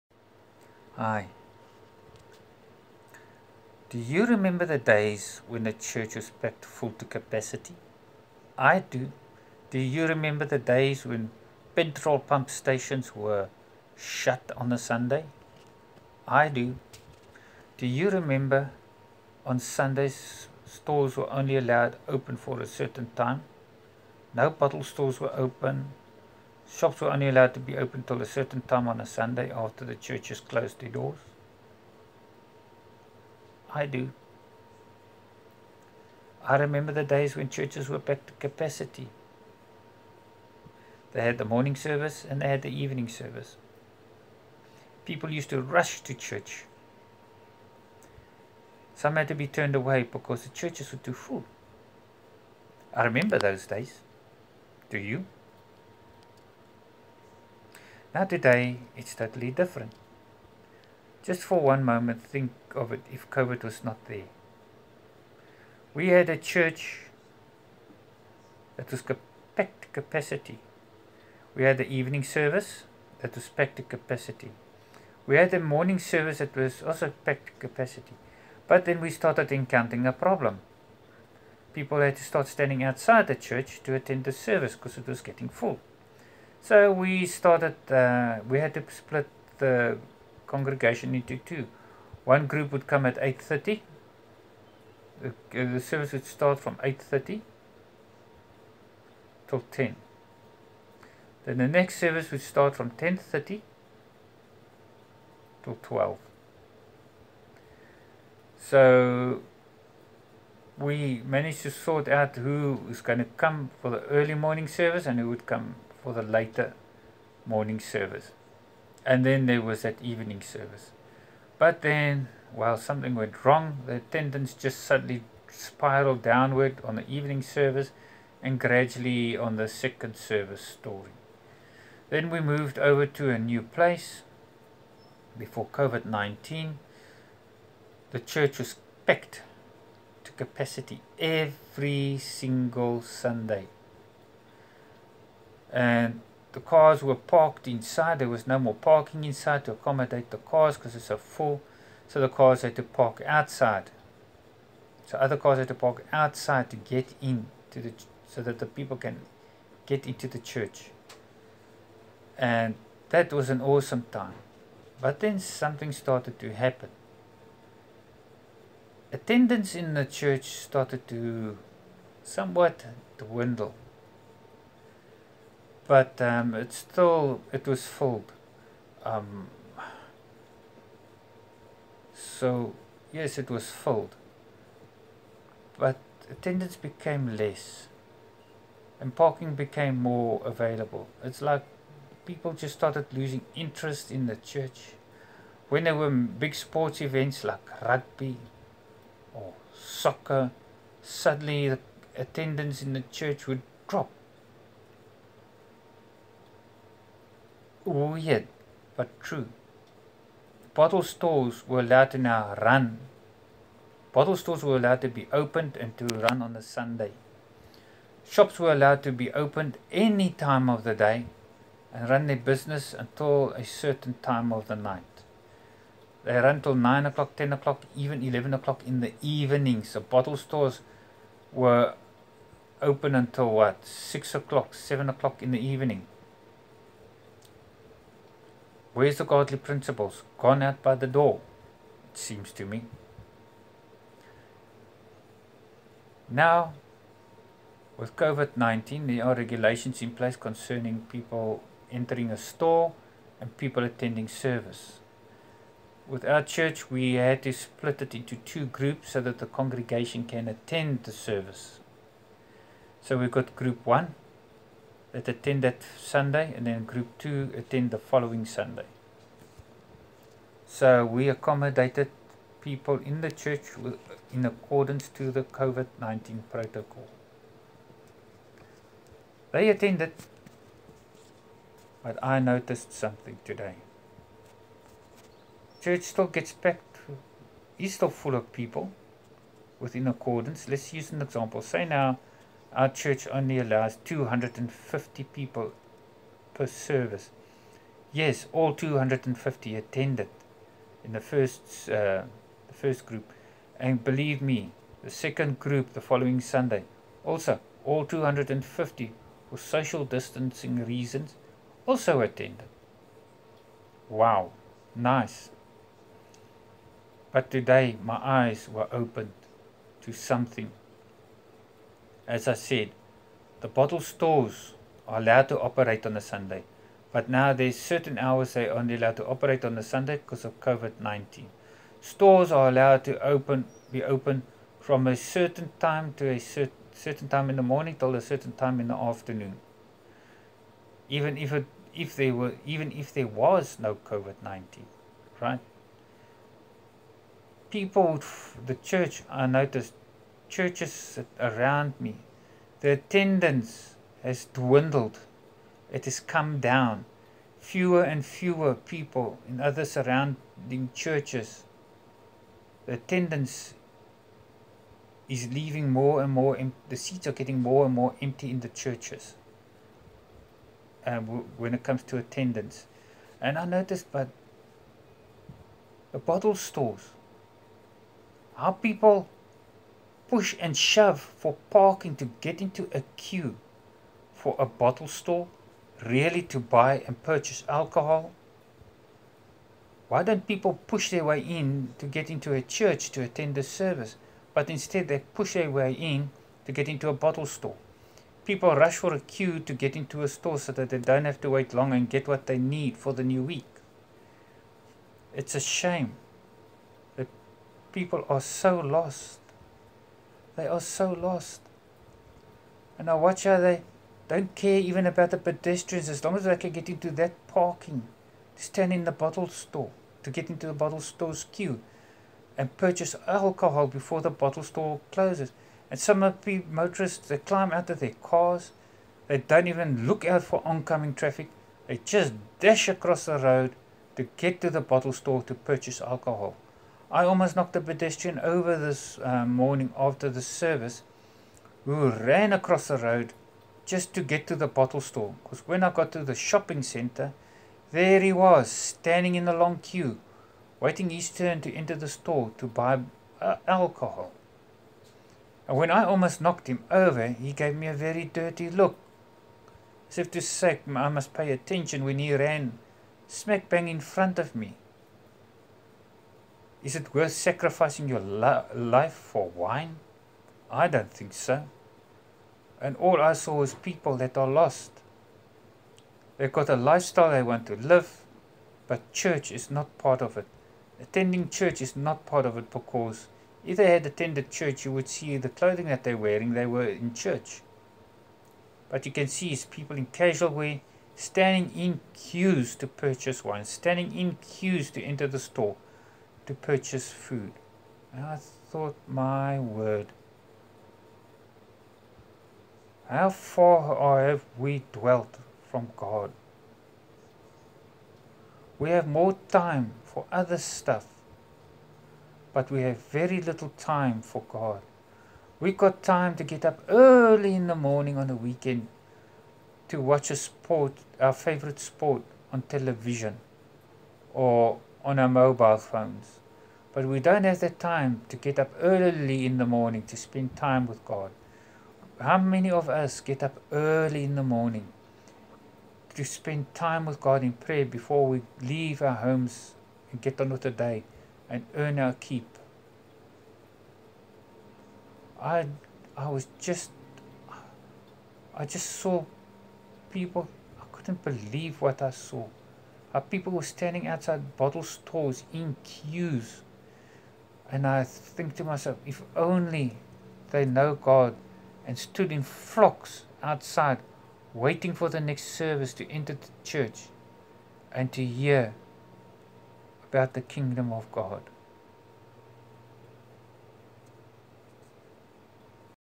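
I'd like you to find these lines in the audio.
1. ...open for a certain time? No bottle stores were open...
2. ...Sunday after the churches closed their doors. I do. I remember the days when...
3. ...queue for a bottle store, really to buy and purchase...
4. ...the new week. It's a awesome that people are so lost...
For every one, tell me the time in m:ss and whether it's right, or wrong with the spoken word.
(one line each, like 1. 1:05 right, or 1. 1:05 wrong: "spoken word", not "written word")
1. 0:22 right
2. 0:29 right
3. 6:23 right
4. 6:43 wrong: "shame", not "awesome".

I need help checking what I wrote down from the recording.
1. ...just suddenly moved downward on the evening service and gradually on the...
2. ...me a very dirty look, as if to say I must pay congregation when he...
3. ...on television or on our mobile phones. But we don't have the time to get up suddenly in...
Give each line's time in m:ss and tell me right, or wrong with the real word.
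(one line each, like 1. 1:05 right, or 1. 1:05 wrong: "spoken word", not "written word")
1. 2:04 wrong: "spiraled", not "moved"
2. 7:37 wrong: "attention", not "congregation"
3. 8:42 wrong: "early", not "suddenly".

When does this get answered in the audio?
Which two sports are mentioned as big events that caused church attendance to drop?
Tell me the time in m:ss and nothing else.
3:17.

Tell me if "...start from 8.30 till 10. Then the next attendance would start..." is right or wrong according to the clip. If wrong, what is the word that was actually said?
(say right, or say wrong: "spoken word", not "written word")
wrong: "service", not "attendance".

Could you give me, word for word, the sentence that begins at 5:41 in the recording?
Even if it, if there were, even if there was no COVID-19, right?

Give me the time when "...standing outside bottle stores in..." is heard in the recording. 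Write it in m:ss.
9:13.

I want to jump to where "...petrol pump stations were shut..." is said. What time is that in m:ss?
0:11.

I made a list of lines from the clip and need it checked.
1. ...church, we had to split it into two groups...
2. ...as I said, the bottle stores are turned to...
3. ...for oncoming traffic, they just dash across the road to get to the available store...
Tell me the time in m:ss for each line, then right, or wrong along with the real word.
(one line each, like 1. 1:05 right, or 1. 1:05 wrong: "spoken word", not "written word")
1. 4:16 right
2. 5:22 wrong: "allowed", not "turned"
3. 7:10 wrong: "bottle", not "available".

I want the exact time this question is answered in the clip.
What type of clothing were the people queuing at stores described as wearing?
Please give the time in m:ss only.
8:10.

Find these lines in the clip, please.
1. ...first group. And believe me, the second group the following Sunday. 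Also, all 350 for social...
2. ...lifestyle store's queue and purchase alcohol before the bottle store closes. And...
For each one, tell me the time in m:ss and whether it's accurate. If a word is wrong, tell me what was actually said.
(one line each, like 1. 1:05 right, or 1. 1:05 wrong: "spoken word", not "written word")
1. 5:02 wrong: "250", not "350"
2. 7:00 wrong: "bottle", not "lifestyle".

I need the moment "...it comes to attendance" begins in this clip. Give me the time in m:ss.
6:11.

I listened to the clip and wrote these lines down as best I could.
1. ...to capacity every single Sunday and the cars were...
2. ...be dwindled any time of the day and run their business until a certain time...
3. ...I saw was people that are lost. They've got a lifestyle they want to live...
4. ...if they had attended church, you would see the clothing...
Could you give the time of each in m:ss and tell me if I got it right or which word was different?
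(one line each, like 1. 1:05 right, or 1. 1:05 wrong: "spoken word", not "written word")
1. 2:20 right
2. 3:39 wrong: "opened", not "dwindled"
3. 7:53 right
4. 8:03 right.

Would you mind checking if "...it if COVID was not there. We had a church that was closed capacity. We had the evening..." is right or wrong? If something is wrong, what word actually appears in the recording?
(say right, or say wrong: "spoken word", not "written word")
wrong: "packed", not "closed".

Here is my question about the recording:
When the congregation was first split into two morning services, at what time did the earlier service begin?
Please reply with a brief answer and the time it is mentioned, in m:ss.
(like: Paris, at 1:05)
8:30, at 1:32.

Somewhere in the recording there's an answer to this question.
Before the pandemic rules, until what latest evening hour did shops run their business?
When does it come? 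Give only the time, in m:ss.
3:47.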